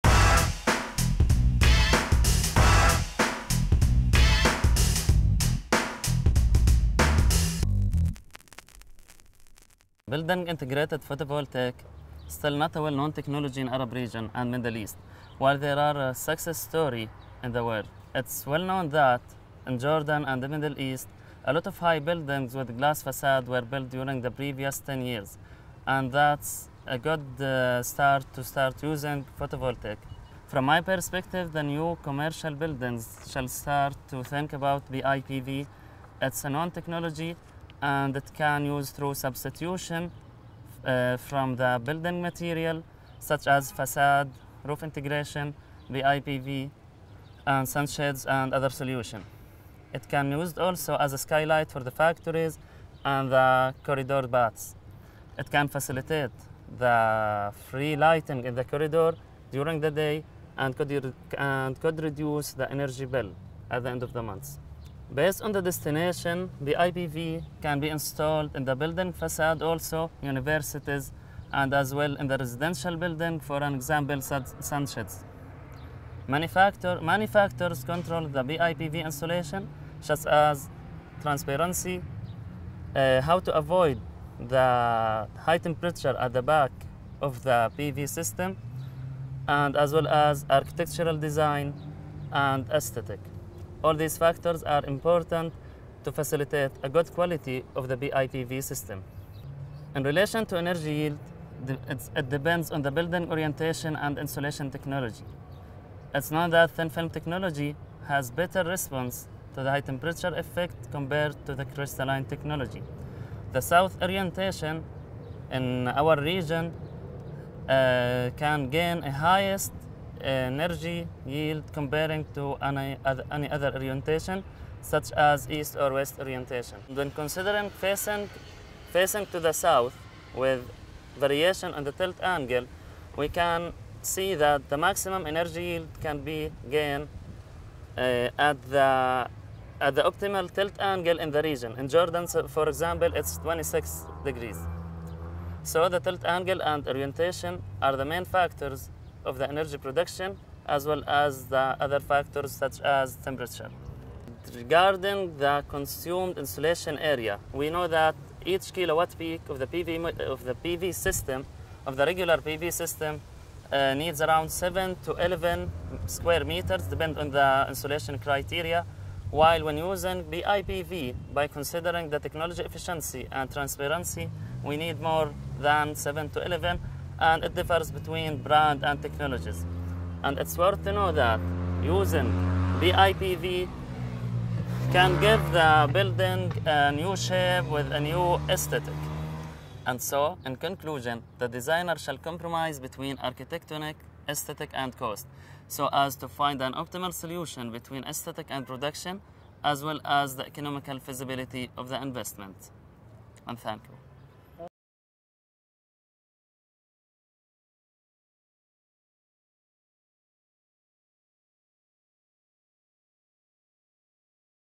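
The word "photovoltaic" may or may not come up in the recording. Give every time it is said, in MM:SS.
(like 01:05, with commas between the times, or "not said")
00:11, 00:29.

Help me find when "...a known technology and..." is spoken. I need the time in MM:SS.
00:36.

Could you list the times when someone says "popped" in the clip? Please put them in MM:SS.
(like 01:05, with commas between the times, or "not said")
not said.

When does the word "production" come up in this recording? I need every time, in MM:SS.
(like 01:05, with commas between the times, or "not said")
02:29, 03:18.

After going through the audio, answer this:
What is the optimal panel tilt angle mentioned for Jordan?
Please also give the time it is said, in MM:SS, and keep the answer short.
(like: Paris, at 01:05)
26 degrees, at 02:23.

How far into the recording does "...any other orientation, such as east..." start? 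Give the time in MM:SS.
02:03.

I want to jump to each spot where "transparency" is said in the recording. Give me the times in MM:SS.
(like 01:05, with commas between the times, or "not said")
01:21, 02:53.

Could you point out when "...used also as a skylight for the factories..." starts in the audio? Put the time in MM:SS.
00:50.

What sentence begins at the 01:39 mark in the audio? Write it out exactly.
In relation to energy yield, it depends on the building orientation and insulation technology.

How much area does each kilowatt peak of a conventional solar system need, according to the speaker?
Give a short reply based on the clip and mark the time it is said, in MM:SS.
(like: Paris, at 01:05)
7 to 11 square meters, at 02:44.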